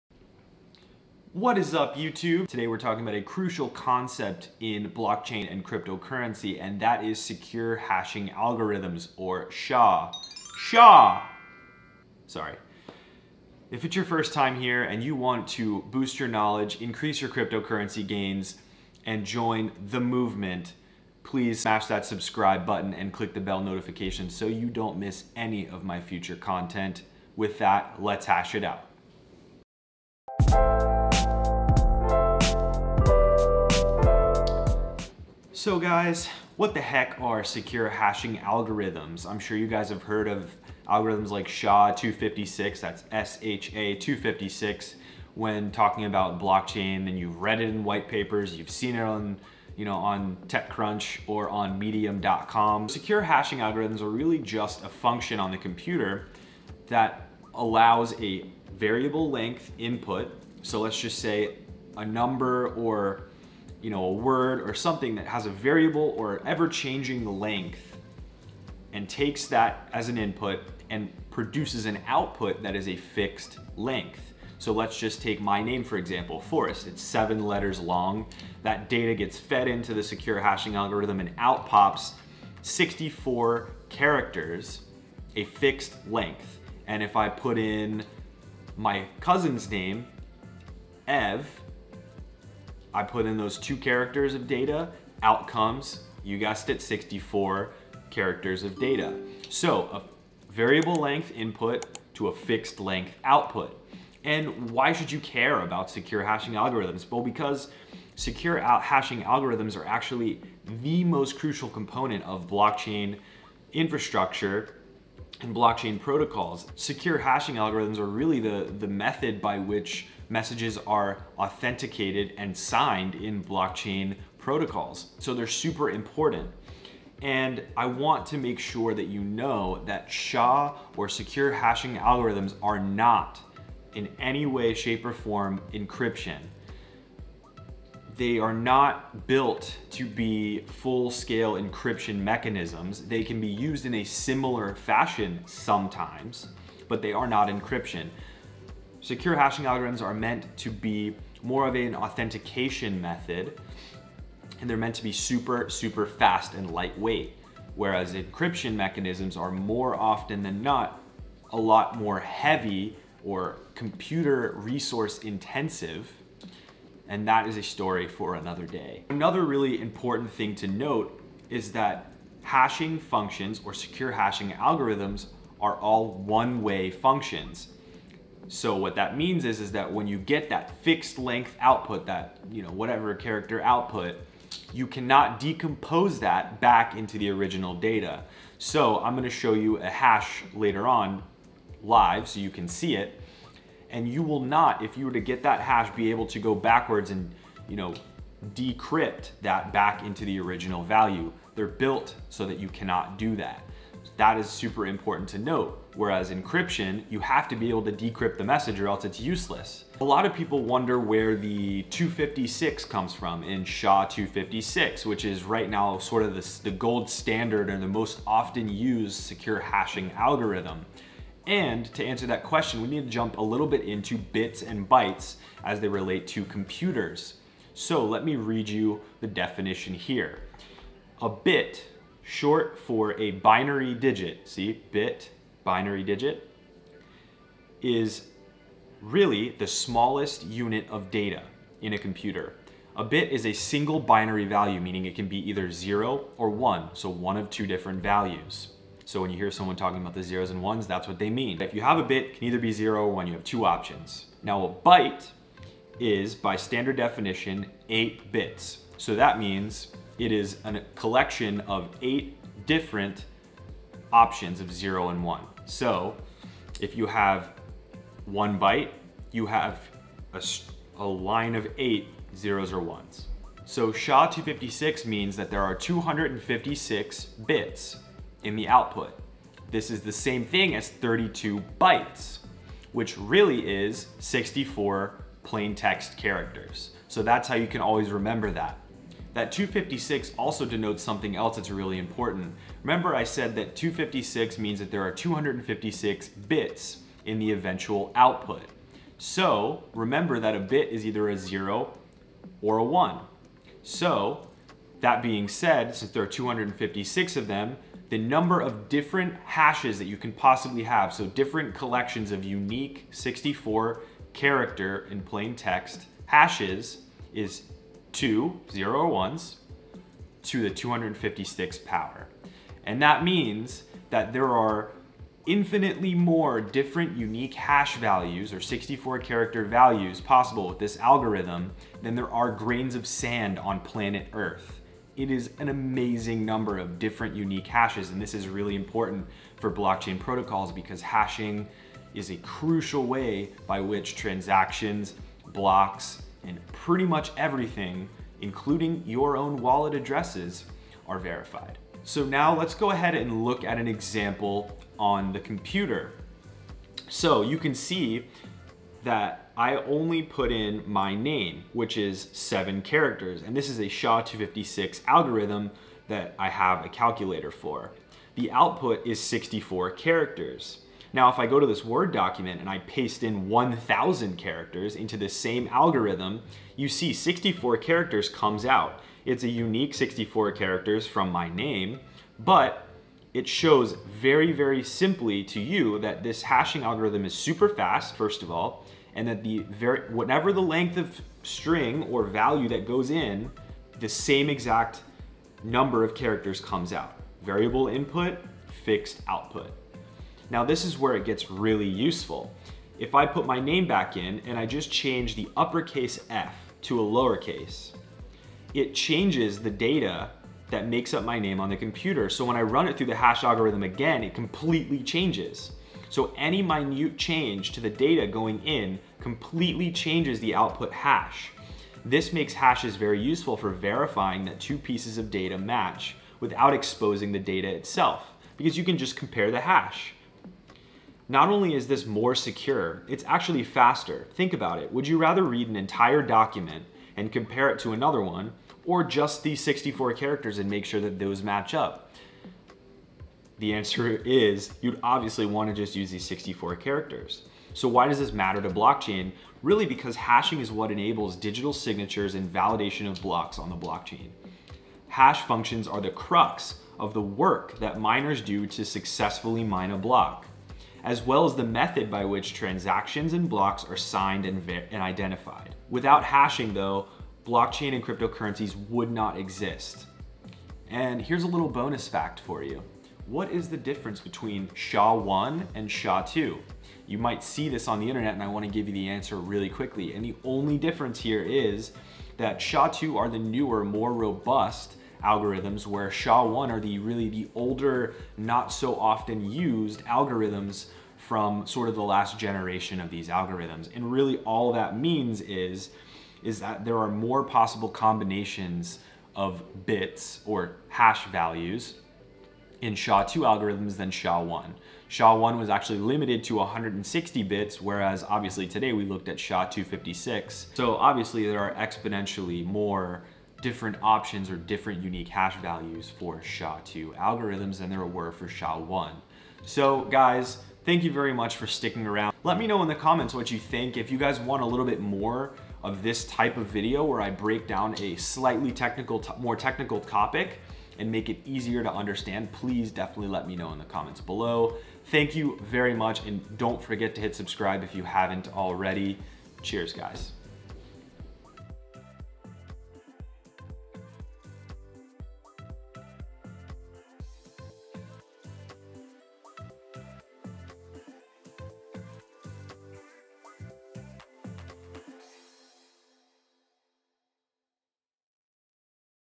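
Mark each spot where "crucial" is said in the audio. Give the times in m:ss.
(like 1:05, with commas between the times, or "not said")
0:03, 1:51, 5:42.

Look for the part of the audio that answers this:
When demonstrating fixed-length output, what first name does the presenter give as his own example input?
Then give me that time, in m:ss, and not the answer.
1:16.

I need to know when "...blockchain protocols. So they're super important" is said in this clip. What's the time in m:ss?
2:03.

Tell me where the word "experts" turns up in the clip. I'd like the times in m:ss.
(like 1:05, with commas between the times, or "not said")
not said.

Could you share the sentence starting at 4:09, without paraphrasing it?
So when you hear someone talking about the zeros and ones, that's what they mean.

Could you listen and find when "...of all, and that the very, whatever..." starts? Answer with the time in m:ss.
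6:28.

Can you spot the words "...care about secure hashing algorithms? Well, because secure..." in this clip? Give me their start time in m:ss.
1:45.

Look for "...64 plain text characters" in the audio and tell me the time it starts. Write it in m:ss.
4:44.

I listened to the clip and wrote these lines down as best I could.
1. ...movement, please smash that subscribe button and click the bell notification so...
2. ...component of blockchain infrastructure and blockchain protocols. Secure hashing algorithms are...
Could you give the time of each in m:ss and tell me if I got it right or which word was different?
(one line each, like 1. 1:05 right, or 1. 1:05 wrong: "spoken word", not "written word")
1. 0:20 right
2. 1:51 right.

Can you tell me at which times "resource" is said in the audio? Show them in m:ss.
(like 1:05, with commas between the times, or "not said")
2:44.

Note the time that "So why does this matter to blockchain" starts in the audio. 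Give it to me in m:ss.
7:27.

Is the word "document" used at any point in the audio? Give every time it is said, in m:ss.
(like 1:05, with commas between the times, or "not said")
6:12, 7:16.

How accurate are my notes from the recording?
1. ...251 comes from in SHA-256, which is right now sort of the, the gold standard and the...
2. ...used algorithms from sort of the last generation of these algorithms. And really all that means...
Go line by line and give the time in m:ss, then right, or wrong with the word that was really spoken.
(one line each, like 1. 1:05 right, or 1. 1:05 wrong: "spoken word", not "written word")
1. 3:31 wrong: "256", not "251"
2. 8:09 right.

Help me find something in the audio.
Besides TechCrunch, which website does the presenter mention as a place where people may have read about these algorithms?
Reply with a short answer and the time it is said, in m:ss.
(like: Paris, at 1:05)
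medium.com, at 0:51.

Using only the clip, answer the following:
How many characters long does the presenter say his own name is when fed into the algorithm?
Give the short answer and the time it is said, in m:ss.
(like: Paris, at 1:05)
7, at 1:17.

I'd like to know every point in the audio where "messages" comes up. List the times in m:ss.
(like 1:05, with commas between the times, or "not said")
2:00, 3:28.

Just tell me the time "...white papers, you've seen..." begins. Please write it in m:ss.
0:47.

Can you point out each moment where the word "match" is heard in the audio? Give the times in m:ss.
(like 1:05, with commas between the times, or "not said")
7:05, 7:21.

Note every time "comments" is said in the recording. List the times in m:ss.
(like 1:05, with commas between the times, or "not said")
8:42, 8:53.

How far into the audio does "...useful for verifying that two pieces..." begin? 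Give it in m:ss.
7:03.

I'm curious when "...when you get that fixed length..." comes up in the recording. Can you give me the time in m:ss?
2:59.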